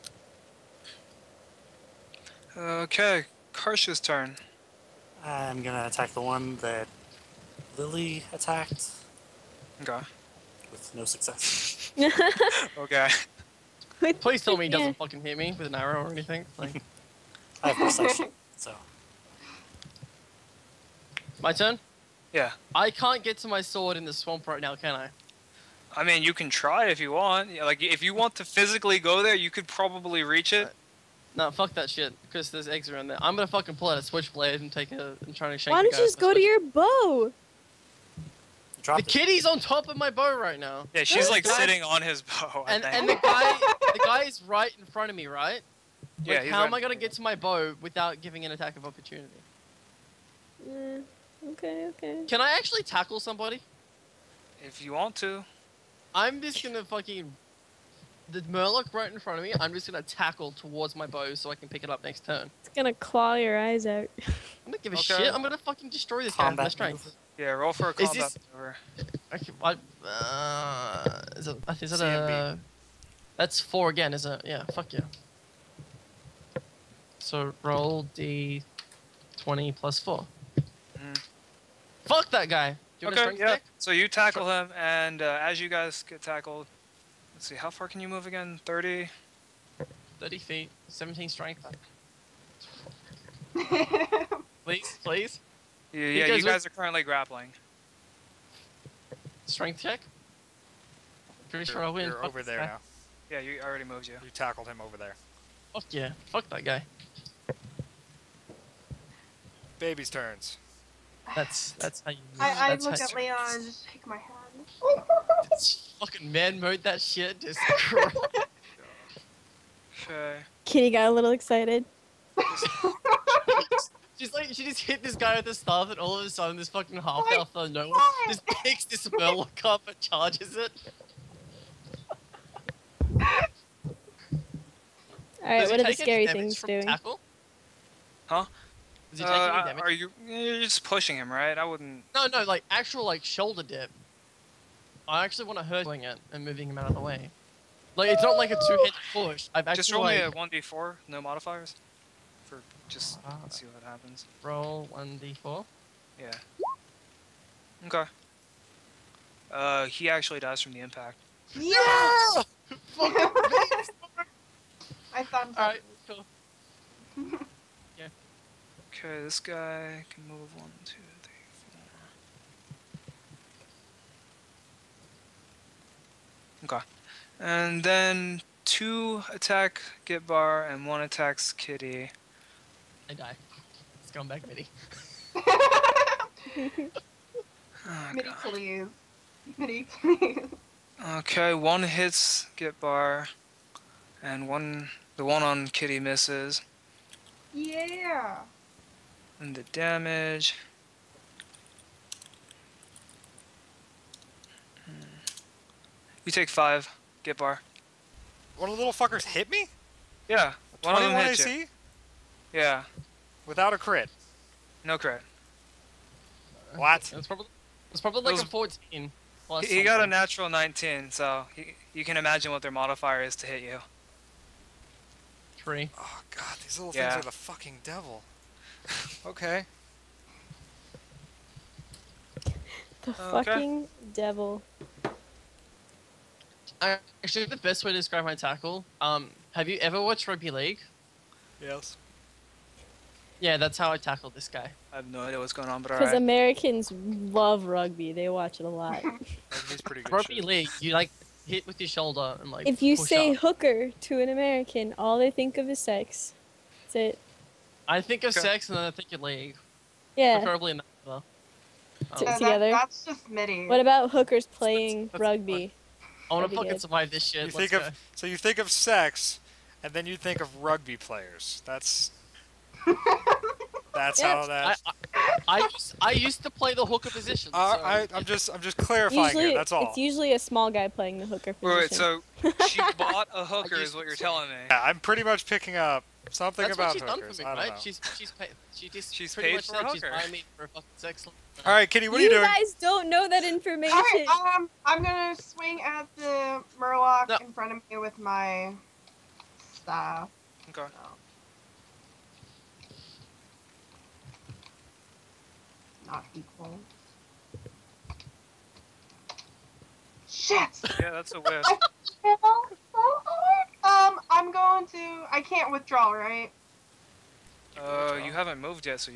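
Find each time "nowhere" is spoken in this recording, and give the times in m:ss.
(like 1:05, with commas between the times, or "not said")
2:07.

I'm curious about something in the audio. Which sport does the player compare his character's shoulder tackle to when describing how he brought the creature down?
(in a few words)
rugby league.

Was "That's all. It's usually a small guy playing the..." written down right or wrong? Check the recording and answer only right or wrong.
right.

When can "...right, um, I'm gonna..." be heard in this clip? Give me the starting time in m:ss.
4:54.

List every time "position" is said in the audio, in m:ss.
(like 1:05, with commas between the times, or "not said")
4:37, 4:41.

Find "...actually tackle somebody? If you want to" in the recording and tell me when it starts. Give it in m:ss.
0:52.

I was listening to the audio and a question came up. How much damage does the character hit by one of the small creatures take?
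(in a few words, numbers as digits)
5.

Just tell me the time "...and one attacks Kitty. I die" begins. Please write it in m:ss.
3:00.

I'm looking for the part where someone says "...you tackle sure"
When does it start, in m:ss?
1:23.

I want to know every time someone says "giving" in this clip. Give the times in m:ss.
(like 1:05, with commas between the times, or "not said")
0:48, 1:04.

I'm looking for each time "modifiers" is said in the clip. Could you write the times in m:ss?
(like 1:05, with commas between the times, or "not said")
2:31, 3:42.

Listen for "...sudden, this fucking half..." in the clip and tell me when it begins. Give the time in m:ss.
2:06.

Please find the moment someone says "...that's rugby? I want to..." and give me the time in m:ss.
4:25.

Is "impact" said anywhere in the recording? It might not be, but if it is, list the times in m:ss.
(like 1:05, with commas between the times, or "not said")
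2:40.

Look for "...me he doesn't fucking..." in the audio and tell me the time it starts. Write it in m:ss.
0:14.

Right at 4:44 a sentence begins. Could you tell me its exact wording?
Yeah, I'm pretty much picking up something That's about what hookers.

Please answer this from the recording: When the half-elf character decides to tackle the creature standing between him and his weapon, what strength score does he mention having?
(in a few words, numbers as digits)
17.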